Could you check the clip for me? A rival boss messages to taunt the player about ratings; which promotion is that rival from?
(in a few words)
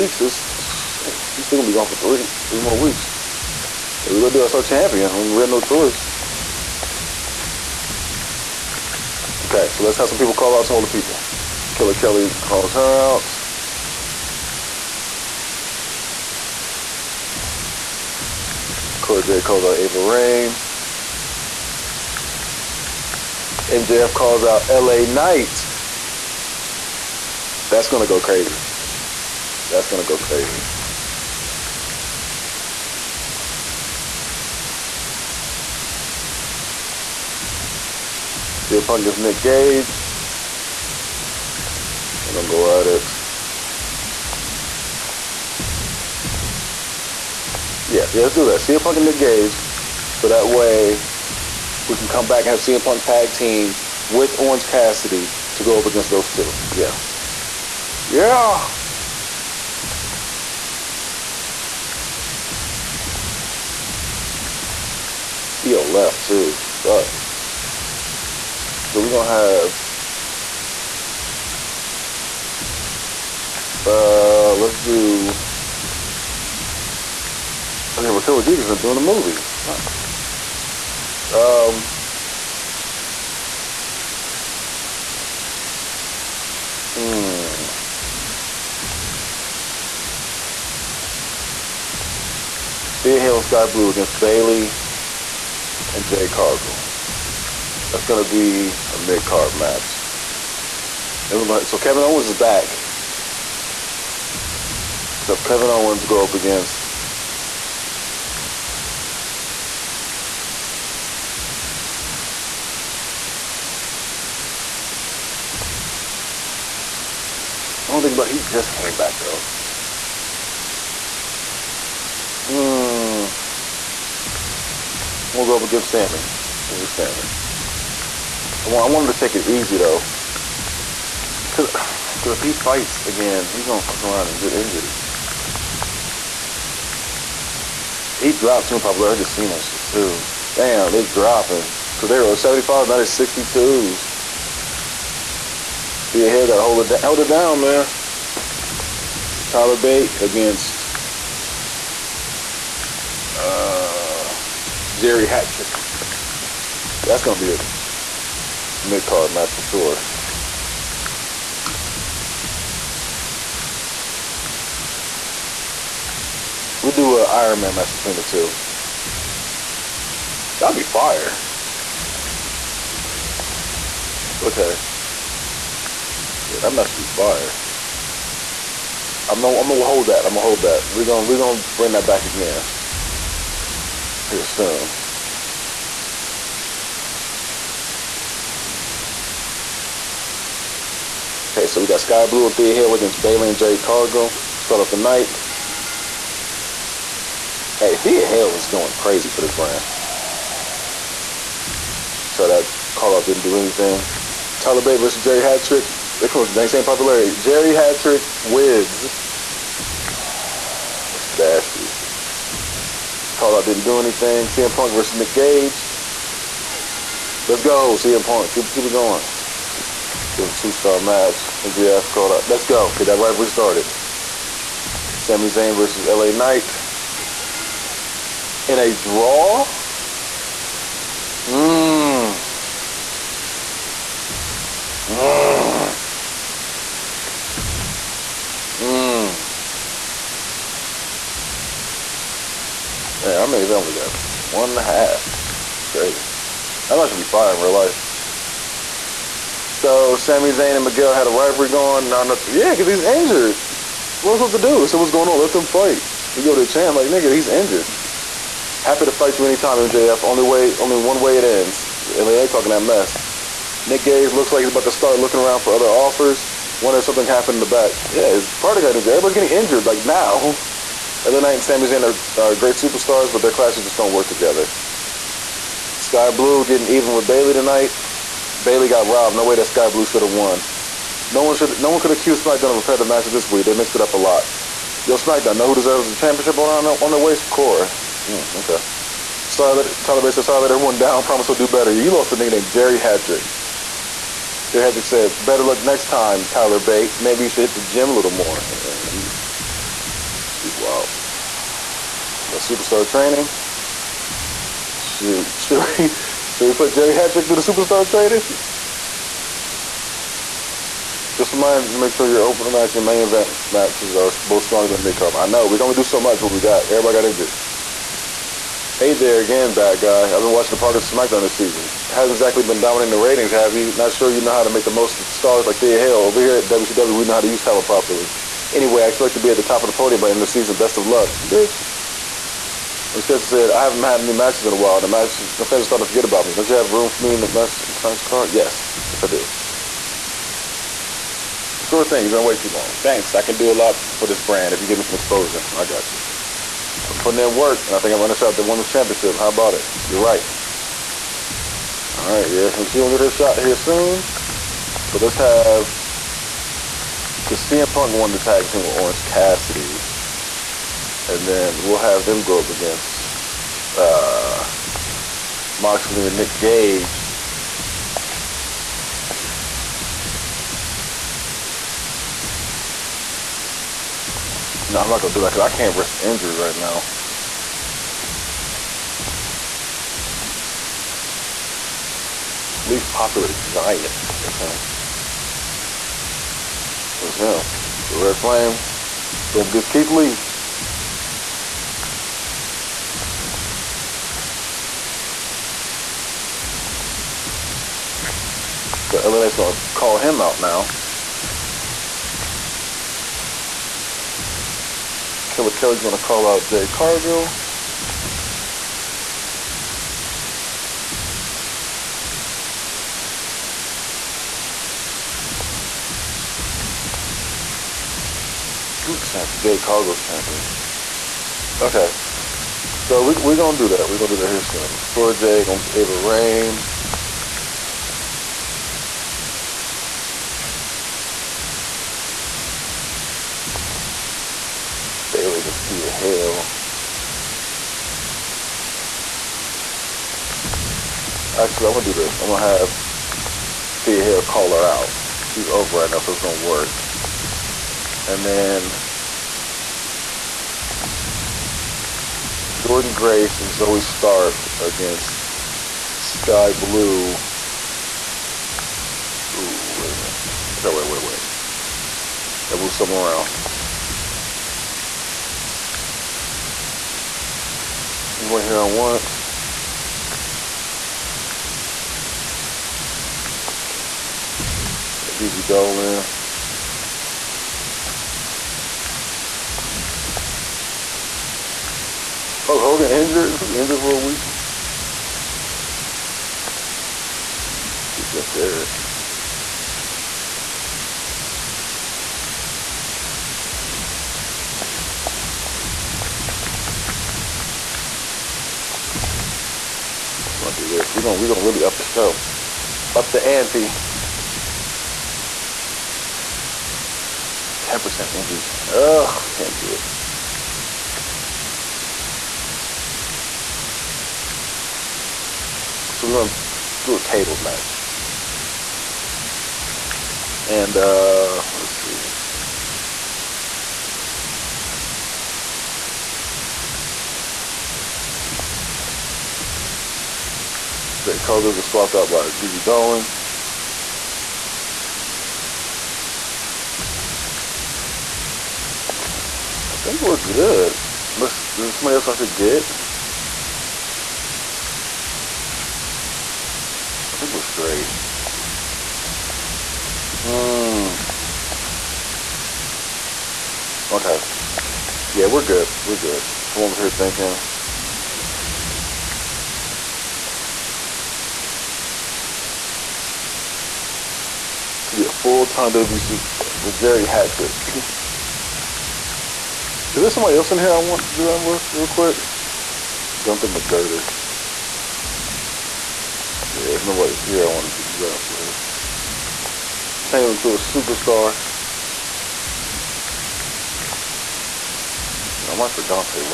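WCW.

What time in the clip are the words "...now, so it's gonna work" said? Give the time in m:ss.
7:26.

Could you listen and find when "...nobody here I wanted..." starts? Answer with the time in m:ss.
9:37.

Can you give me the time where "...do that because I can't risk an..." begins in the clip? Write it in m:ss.
6:15.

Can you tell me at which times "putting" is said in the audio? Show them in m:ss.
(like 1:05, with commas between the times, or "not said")
5:47.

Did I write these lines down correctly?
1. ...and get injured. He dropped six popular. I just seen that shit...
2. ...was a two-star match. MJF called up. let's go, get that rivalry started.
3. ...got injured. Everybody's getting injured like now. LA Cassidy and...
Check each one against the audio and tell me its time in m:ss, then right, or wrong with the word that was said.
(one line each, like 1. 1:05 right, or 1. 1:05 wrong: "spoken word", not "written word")
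1. 2:14 wrong: "two", not "six"
2. 3:40 right
3. 4:28 wrong: "Knight", not "Cassidy".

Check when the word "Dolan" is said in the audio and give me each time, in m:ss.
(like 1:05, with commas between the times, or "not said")
7:55, 8:52.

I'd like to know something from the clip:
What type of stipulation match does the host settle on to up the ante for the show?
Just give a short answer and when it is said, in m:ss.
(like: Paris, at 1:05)
Tables match, at 8:37.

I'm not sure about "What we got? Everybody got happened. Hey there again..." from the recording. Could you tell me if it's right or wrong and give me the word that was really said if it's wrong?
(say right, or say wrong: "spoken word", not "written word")
wrong: "injured", not "happened".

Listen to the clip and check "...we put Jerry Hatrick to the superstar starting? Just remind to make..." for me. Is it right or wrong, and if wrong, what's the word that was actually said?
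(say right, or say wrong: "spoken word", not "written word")
wrong: "trading", not "starting".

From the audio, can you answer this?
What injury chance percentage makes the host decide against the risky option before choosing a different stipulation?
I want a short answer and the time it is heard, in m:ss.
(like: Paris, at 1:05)
10%, at 8:27.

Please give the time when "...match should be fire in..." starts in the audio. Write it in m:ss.
4:06.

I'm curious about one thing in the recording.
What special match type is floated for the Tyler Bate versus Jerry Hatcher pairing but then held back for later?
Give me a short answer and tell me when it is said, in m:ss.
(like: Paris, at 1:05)
Iron Man match, at 2:47.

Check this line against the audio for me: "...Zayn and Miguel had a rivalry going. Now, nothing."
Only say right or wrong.
right.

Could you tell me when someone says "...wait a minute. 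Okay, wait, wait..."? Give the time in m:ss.
7:39.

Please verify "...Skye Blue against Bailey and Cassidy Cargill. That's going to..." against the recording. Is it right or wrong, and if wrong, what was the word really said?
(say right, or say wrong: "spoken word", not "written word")
wrong: "Jade", not "Cassidy".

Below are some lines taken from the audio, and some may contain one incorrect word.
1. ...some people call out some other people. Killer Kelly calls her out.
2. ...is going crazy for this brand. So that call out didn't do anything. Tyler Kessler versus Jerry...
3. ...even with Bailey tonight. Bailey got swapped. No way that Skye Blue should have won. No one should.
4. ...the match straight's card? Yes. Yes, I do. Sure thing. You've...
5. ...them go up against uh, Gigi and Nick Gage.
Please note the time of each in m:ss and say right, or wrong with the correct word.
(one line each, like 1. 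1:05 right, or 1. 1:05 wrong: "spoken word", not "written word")
1. 0:10 right
2. 3:18 wrong: "Bate", not "Kessler"
3. 4:36 wrong: "robbed", not "swapped"
4. 5:37 wrong: "tonight", not "straight"
5. 6:02 wrong: "Moxley", not "Gigi".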